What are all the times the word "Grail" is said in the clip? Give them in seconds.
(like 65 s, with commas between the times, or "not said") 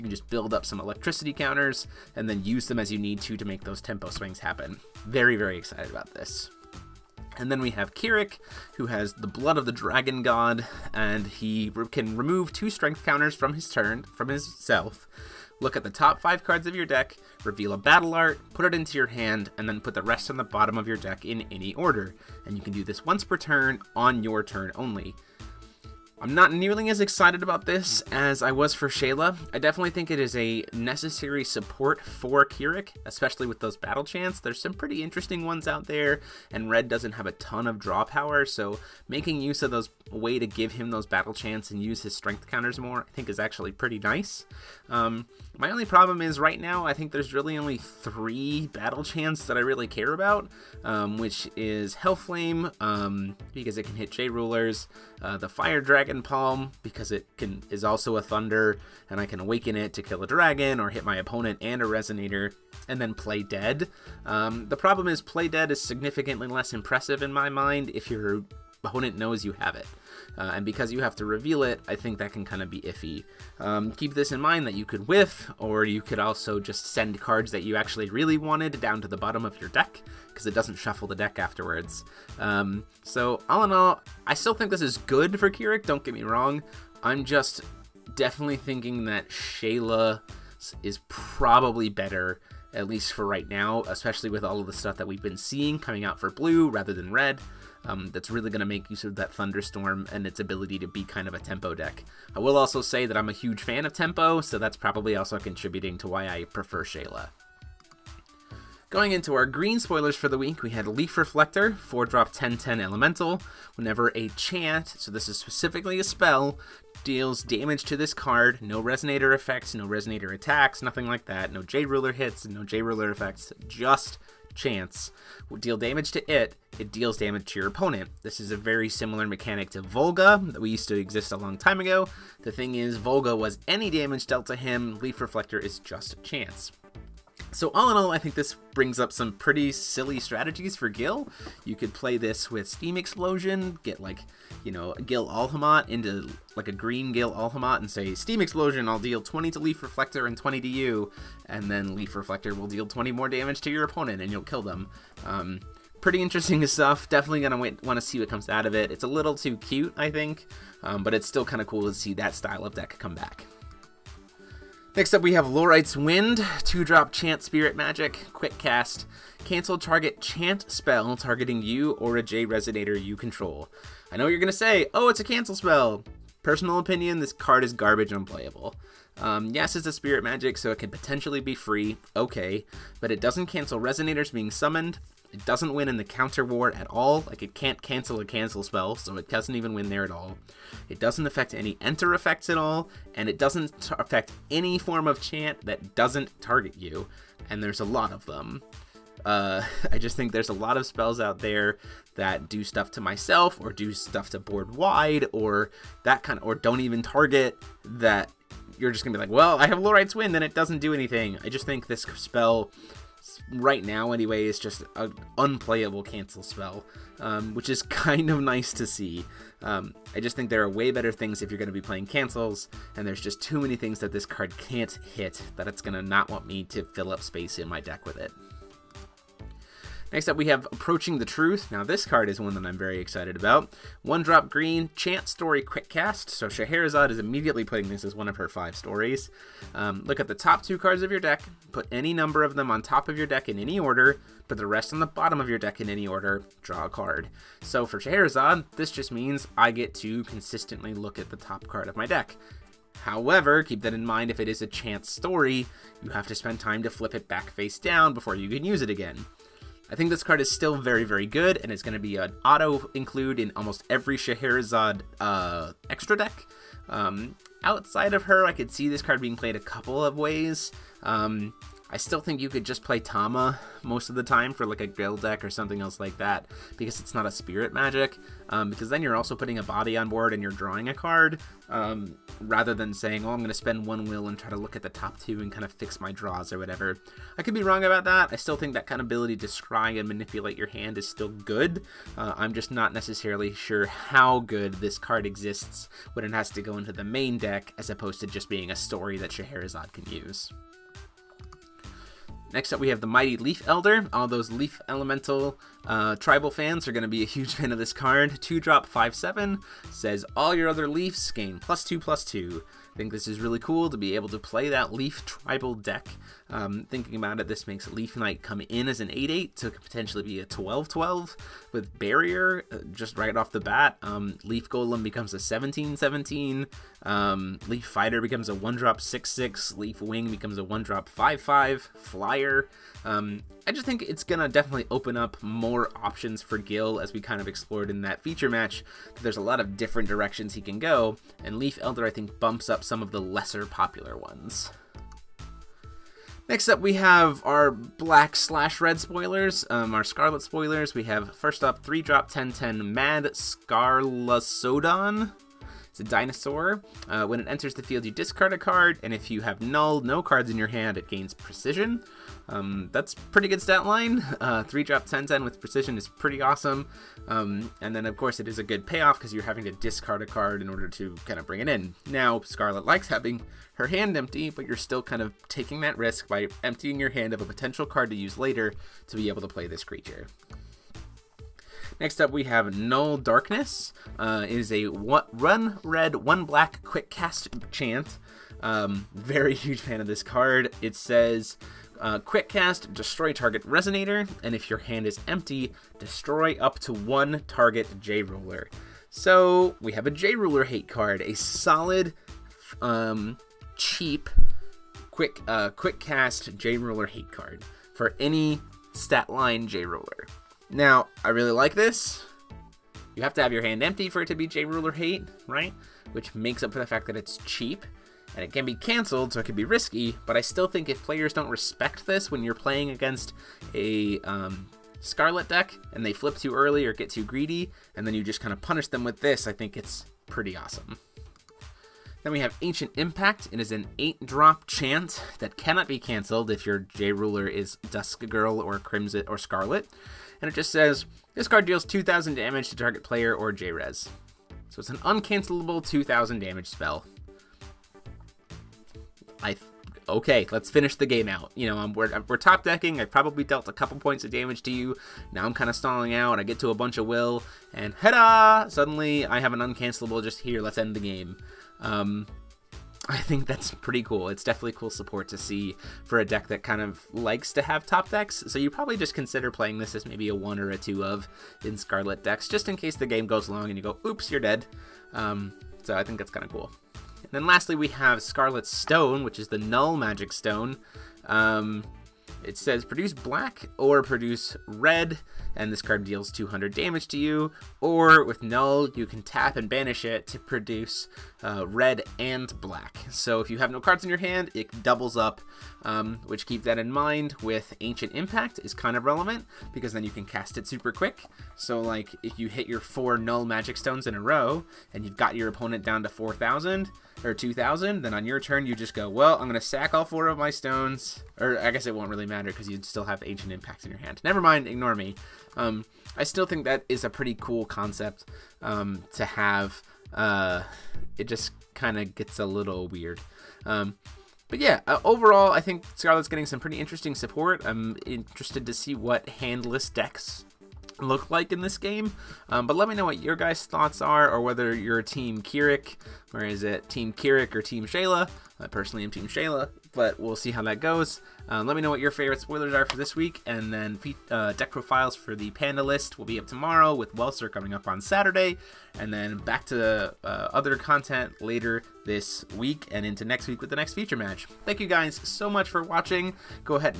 274 s.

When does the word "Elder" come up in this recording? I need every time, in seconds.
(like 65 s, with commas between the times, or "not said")
303 s, 341 s.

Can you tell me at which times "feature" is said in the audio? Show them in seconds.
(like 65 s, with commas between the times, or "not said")
338 s, 553 s.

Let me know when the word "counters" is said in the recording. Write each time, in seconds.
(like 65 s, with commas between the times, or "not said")
1 s, 13 s, 42 s, 186 s.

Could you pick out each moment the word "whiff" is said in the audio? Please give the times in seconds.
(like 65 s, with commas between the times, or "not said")
75 s.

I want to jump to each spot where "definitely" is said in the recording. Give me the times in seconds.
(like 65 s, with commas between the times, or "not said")
29 s, 88 s, 157 s, 334 s, 464 s.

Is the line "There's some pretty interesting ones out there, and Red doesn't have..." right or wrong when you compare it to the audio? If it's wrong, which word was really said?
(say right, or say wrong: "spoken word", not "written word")
right.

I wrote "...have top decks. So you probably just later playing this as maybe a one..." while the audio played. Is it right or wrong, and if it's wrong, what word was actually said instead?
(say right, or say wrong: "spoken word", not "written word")
wrong: "consider", not "later".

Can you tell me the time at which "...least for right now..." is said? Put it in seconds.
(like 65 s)
92 s.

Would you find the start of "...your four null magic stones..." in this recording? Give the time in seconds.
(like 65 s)
502 s.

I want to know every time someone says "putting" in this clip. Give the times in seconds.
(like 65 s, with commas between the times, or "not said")
237 s, 279 s.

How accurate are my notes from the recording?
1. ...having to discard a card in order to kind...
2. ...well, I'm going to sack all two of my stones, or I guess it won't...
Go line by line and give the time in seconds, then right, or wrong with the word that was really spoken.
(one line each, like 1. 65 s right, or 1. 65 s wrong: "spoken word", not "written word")
1. 369 s right
2. 509 s wrong: "four", not "two".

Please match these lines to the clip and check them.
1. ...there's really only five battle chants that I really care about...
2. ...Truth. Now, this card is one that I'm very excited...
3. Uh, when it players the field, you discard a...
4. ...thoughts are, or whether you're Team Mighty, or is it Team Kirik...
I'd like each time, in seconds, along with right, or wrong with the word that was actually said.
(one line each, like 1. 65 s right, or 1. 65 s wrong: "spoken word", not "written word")
1. 47 s wrong: "three", not "five"
2. 231 s right
3. 357 s wrong: "enters", not "players"
4. 533 s wrong: "Kirik", not "Mighty".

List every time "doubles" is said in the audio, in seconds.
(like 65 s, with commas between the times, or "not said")
494 s.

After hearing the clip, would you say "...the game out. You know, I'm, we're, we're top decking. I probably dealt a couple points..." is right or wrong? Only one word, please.
right.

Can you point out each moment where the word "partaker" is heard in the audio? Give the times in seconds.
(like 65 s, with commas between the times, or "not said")
not said.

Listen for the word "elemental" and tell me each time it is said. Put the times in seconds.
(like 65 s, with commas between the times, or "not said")
112 s, 304 s.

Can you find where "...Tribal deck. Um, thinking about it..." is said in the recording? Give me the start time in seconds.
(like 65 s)
315 s.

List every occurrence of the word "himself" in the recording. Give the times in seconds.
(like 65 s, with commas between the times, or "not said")
not said.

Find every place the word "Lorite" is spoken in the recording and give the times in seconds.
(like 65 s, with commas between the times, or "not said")
165 s, 209 s.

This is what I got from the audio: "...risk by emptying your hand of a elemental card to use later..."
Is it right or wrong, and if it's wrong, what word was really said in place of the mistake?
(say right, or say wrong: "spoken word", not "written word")
wrong: "potential", not "elemental".